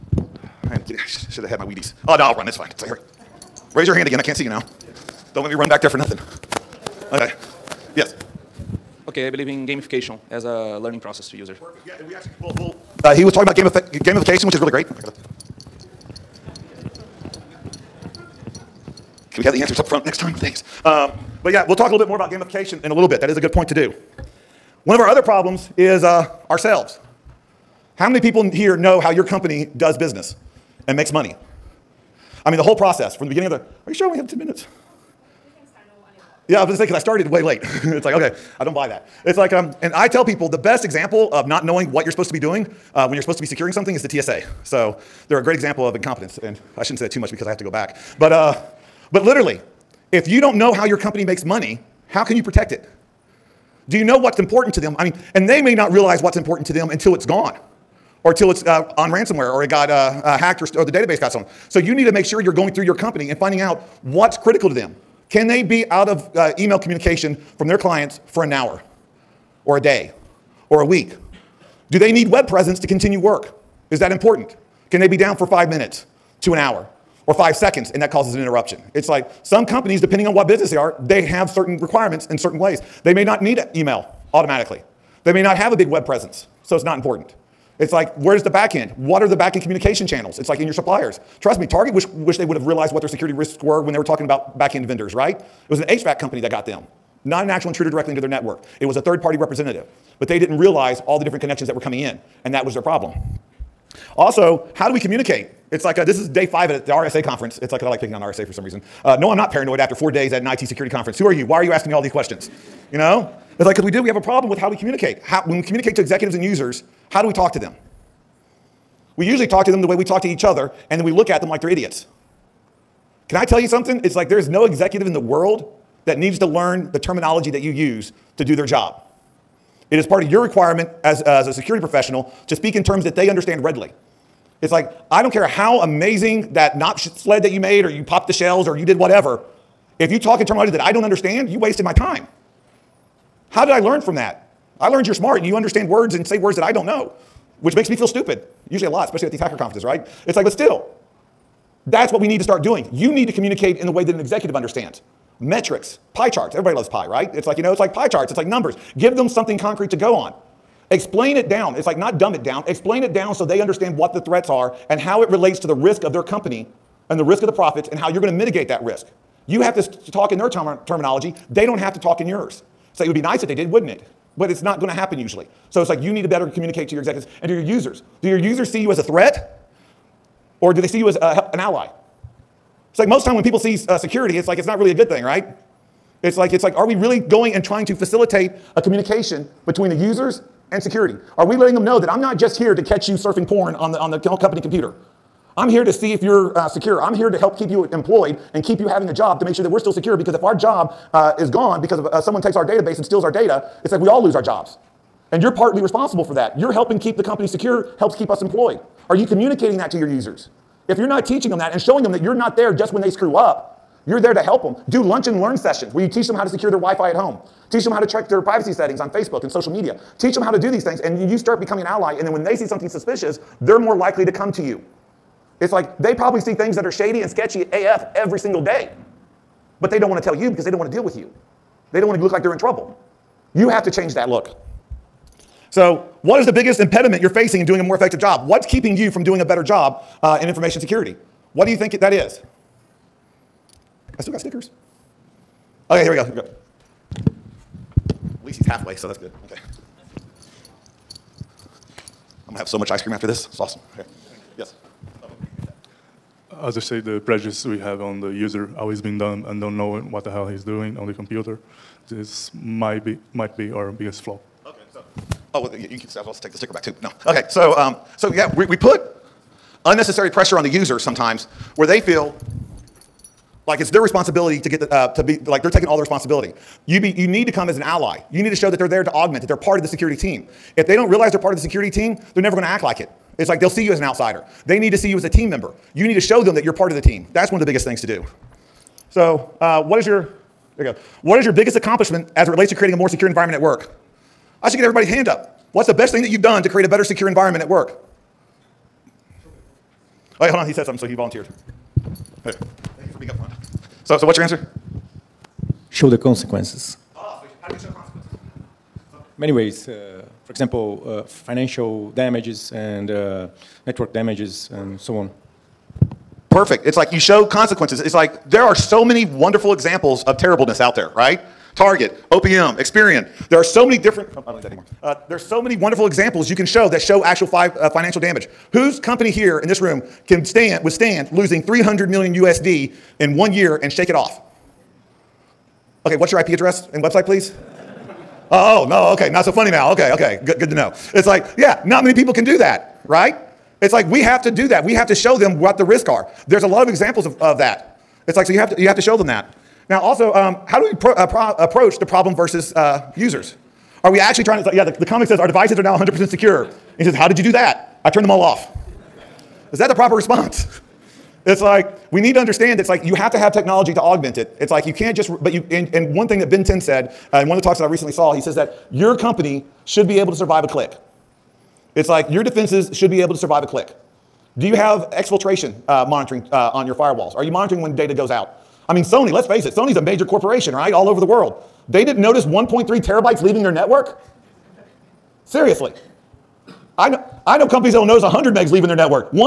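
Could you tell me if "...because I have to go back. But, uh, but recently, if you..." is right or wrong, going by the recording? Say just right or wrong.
wrong.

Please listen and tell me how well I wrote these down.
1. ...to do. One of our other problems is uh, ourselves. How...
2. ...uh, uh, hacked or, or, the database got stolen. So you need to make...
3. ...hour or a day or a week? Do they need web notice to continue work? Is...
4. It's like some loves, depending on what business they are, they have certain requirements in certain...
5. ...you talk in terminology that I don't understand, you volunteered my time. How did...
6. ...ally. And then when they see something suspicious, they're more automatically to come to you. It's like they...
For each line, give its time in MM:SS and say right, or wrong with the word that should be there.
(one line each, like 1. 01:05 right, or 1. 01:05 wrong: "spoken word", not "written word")
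1. 00:23 right
2. 00:59 right
3. 01:08 wrong: "presence", not "notice"
4. 01:18 wrong: "companies", not "loves"
5. 02:20 wrong: "wasted", not "volunteered"
6. 03:41 wrong: "likely", not "automatically".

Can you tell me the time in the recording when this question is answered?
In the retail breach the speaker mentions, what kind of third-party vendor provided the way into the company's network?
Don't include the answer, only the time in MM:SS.
01:35.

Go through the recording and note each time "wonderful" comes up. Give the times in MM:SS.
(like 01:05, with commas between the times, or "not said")
05:19, 05:25.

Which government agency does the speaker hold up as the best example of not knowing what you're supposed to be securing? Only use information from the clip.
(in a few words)
TSA.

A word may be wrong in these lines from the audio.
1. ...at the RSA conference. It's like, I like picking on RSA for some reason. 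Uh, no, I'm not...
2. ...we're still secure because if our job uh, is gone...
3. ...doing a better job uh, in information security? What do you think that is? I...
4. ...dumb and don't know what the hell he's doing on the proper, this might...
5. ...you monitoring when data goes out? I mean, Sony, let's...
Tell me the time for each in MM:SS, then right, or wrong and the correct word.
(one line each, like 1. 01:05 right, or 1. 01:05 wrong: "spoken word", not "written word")
1. 01:46 right
2. 03:19 right
3. 03:59 right
4. 04:19 wrong: "computer", not "proper"
5. 06:17 right.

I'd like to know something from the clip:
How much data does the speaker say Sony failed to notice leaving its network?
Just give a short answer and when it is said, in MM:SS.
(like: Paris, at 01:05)
1.3 terabytes, at 06:22.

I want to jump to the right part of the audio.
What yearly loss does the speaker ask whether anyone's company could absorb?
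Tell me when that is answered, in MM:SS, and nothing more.
05:31.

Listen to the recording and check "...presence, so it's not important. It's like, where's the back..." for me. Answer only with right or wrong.
right.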